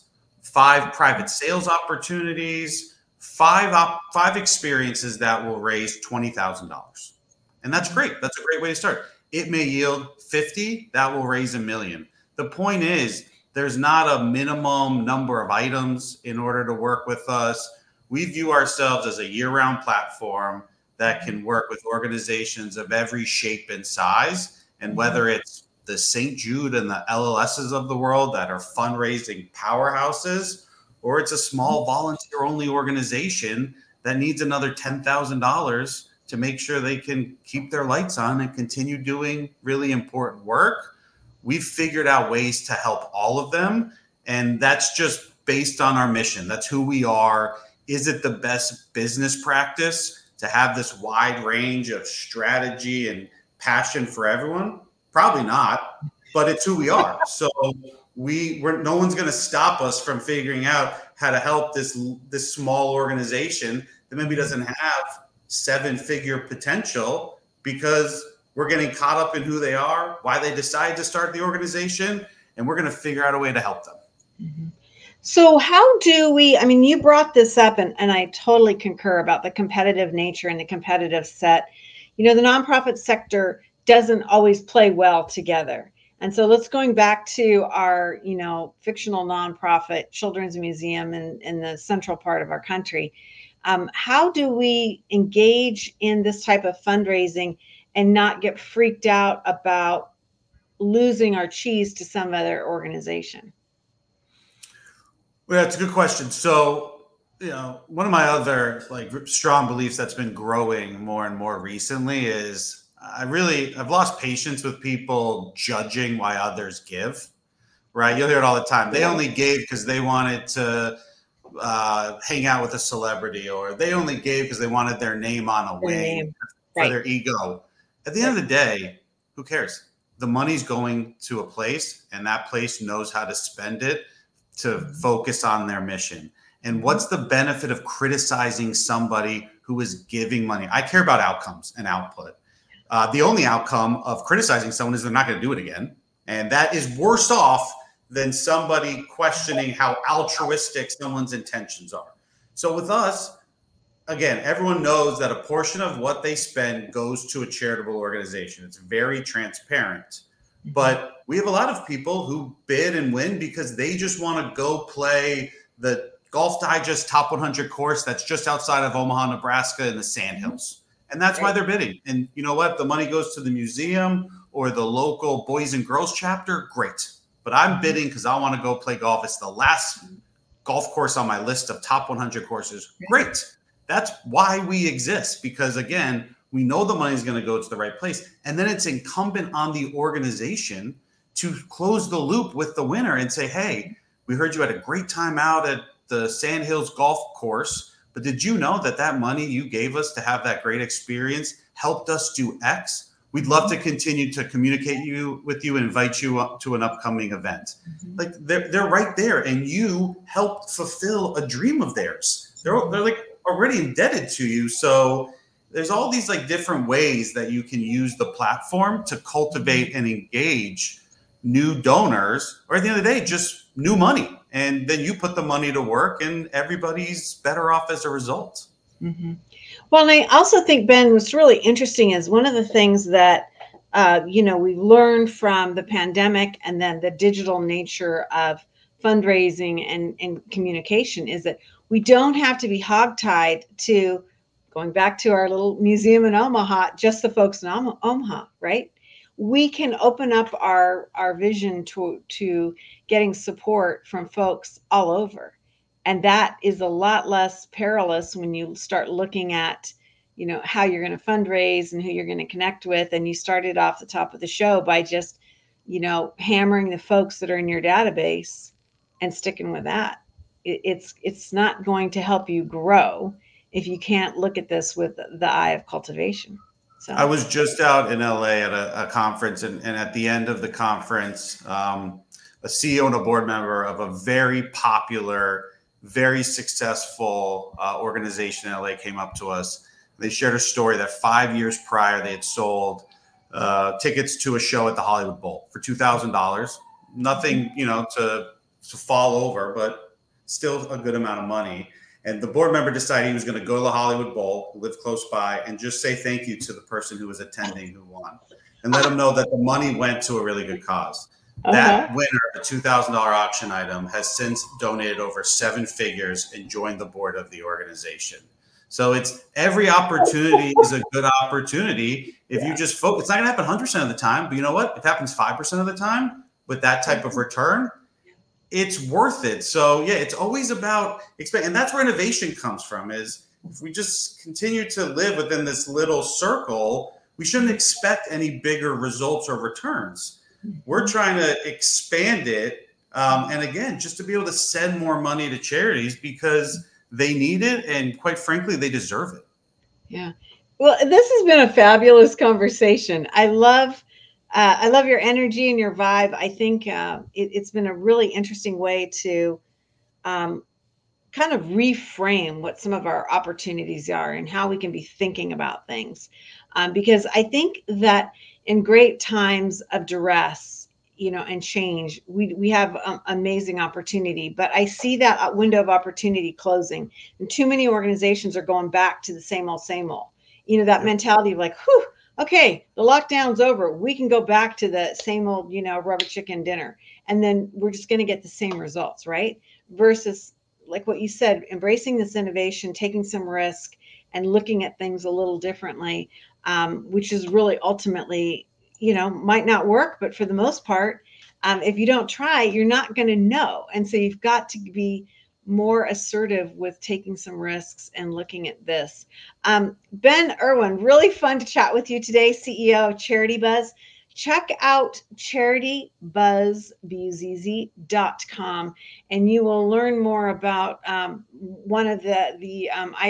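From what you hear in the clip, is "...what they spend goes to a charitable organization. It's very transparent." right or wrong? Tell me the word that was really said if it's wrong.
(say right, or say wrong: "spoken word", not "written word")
right.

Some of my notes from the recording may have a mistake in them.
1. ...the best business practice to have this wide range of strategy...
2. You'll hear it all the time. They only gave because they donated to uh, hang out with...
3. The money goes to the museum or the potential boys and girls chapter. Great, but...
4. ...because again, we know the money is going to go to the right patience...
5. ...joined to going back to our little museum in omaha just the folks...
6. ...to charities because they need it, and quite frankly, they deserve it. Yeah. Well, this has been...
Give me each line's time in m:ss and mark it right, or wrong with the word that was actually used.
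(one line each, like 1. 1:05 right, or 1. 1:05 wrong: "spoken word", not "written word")
1. 0:48 right
2. 1:58 wrong: "wanted", not "donated"
3. 2:52 wrong: "local", not "potential"
4. 3:05 wrong: "place", not "patience"
5. 4:02 wrong: "hogtied", not "joined"
6. 5:45 right.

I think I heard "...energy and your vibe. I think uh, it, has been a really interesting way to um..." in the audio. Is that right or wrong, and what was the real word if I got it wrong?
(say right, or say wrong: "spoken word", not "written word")
right.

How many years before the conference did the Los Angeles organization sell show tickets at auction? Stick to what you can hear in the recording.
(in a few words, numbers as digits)
5.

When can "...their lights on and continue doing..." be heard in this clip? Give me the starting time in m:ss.
0:37.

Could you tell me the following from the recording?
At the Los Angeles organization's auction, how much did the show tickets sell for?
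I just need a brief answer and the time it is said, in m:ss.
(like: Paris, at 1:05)
$2,000, at 4:55.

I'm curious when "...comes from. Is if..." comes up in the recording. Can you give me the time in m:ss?
5:32.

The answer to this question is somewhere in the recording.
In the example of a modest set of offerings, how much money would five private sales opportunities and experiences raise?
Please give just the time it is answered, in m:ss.
0:05.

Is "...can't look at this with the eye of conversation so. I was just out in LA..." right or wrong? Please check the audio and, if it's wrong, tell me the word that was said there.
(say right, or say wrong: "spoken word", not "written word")
wrong: "cultivation", not "conversation".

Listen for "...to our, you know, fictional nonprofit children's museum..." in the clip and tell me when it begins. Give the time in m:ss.
1:27.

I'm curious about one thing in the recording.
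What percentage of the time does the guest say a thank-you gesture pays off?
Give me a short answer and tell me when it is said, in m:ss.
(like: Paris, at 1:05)
5%, at 5:25.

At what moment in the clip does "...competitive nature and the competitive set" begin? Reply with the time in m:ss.
1:19.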